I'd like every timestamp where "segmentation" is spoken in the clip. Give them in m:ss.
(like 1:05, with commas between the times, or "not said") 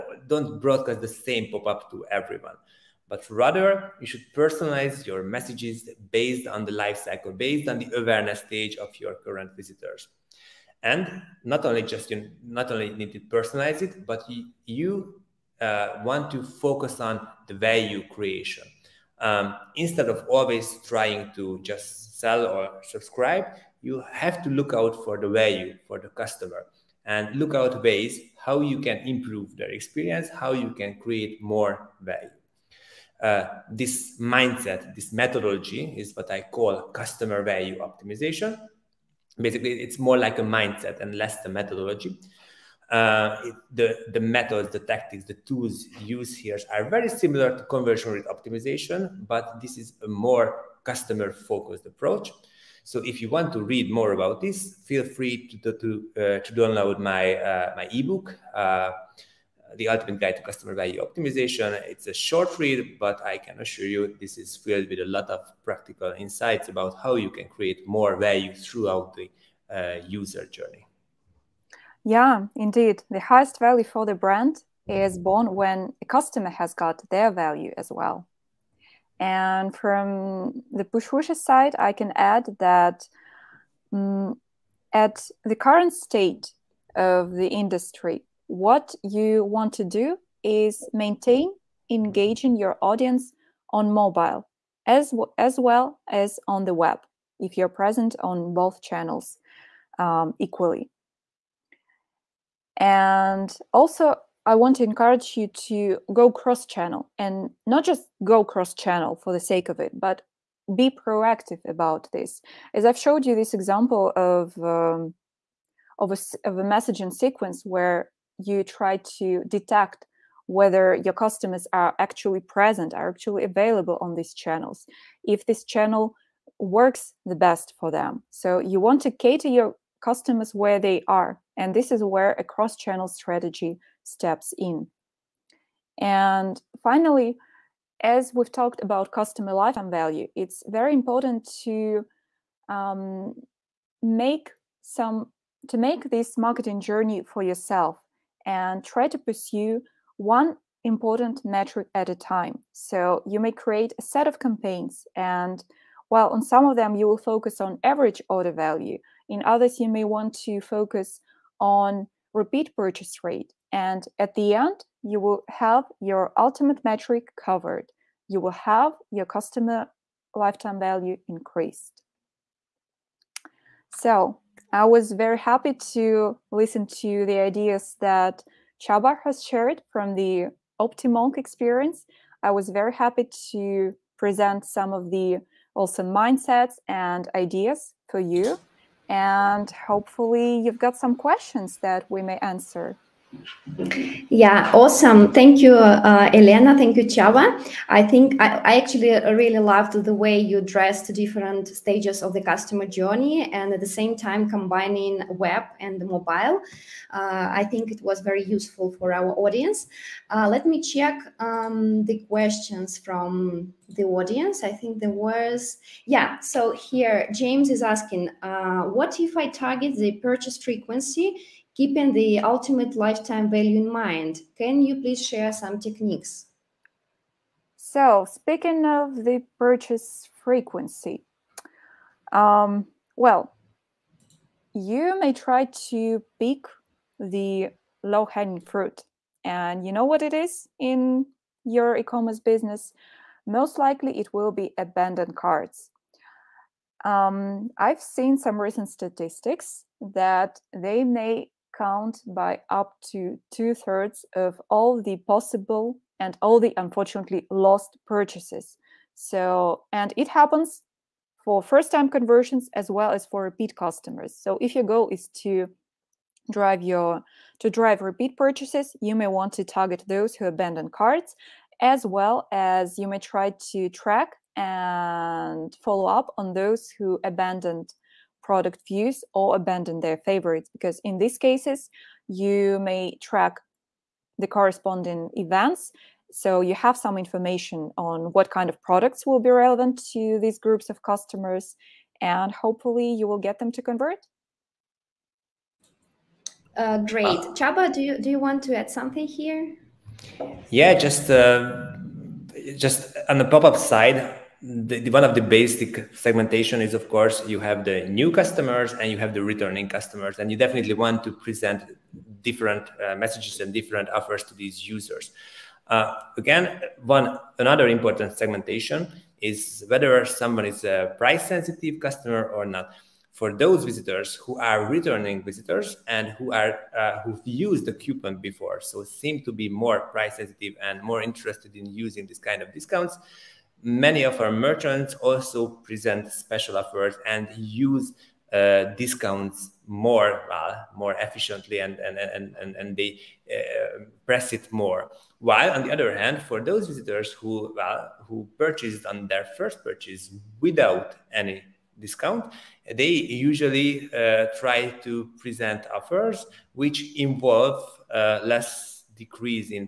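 5:06, 5:18.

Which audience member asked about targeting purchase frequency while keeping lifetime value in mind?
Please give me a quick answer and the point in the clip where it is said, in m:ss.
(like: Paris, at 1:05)
James, at 3:37.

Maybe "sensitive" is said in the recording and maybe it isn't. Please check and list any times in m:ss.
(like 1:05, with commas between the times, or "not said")
5:21, 5:30.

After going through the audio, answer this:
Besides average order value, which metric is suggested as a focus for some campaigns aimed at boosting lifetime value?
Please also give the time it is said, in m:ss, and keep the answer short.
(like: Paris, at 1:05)
Repeat purchase rate, at 2:42.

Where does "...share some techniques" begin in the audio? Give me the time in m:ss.
3:45.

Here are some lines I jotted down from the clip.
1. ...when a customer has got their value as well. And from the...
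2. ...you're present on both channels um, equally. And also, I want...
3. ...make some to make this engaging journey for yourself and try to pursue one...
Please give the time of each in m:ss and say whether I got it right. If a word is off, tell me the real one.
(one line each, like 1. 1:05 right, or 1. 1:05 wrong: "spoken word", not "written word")
1. 1:15 right
2. 1:37 right
3. 2:24 wrong: "marketing", not "engaging".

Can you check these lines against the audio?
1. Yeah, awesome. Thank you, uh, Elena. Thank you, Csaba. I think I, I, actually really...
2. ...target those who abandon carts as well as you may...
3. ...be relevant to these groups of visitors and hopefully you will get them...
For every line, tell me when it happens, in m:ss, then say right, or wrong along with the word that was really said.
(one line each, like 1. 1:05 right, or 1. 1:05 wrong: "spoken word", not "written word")
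1. 3:14 right
2. 4:29 right
3. 4:49 wrong: "customers", not "visitors".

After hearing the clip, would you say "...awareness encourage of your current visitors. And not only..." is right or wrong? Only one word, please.
wrong.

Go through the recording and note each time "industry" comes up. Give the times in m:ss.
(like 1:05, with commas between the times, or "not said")
1:27.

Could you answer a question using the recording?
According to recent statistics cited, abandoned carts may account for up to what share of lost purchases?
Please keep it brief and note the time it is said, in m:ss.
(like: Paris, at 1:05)
Two thirds, at 4:13.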